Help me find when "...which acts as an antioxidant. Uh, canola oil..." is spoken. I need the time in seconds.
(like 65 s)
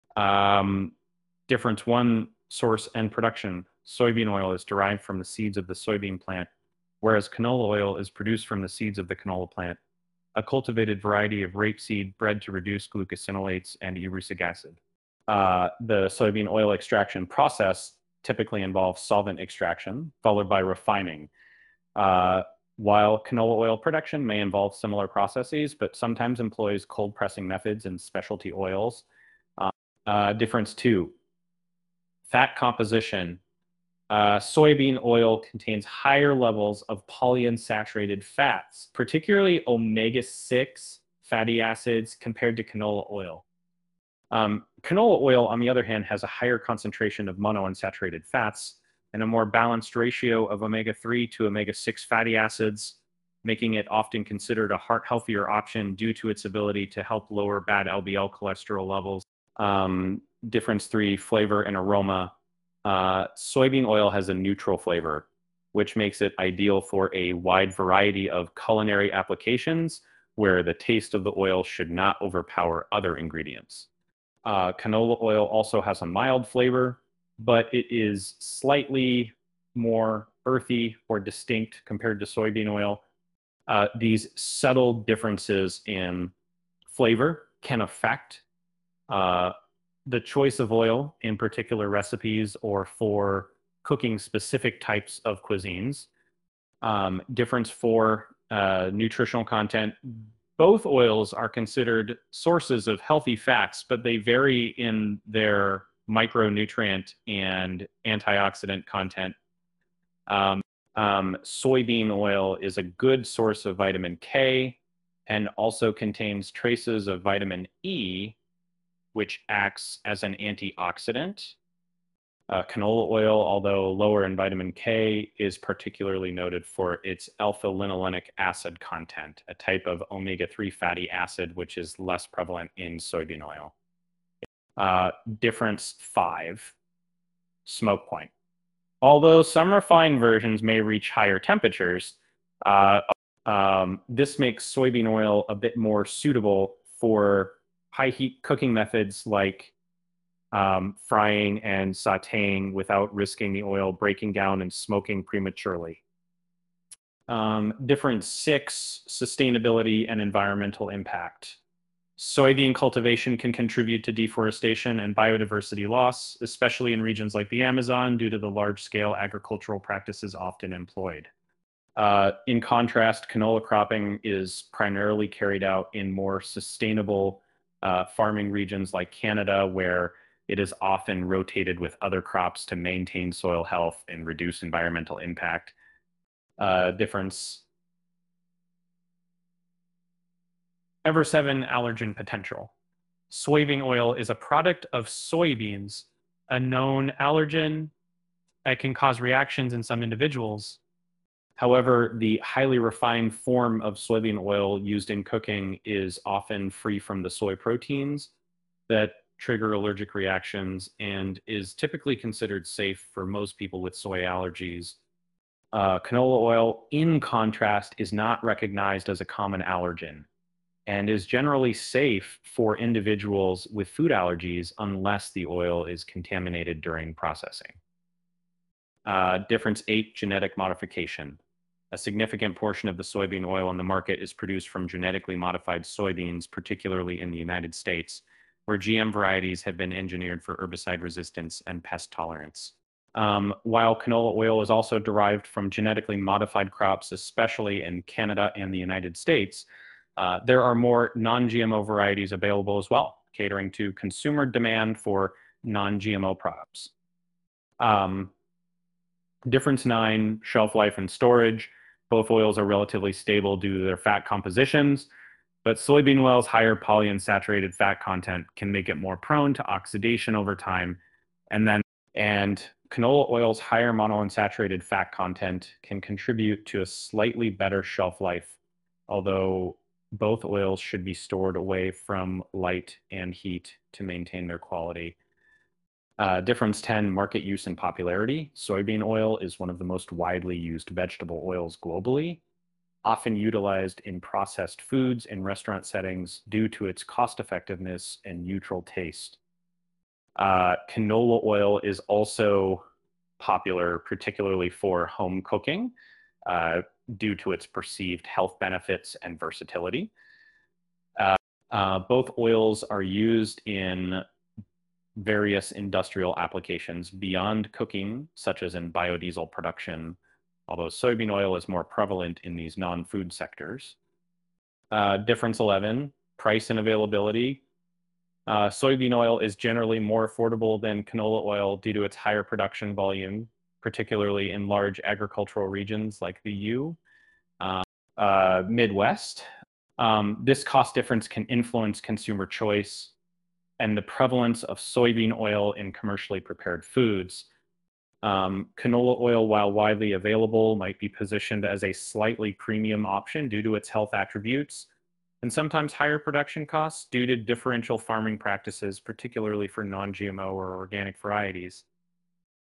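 119 s.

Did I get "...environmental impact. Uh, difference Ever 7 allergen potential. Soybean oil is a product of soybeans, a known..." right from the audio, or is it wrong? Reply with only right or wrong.
right.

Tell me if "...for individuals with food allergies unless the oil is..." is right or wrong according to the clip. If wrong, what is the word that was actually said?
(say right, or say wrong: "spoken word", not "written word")
right.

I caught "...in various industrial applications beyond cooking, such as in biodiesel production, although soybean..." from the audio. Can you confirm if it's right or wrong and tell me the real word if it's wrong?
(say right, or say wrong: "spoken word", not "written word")
right.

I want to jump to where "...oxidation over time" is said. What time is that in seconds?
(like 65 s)
269 s.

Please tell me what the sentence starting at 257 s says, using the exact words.
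Um, difference nine, shelf life and storage.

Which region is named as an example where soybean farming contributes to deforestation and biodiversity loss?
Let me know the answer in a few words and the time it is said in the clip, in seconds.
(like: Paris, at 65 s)
The Amazon, at 167 s.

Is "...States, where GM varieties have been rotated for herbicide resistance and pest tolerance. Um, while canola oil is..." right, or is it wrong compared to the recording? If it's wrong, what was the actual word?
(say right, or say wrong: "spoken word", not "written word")
wrong: "engineered", not "rotated".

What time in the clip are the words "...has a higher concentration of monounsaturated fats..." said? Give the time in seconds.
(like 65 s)
46 s.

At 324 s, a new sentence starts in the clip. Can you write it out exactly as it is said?
Uh, difference 11, price and availability.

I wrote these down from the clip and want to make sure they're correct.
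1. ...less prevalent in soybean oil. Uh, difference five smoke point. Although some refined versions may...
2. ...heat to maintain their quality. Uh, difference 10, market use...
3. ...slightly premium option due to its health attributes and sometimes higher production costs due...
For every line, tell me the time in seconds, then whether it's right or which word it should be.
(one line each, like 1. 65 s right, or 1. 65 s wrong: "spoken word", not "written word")
1. 131 s right
2. 283 s right
3. 351 s right.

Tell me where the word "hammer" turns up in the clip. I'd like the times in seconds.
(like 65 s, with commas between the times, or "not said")
not said.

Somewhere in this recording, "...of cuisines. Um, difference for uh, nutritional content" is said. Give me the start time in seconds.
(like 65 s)
95 s.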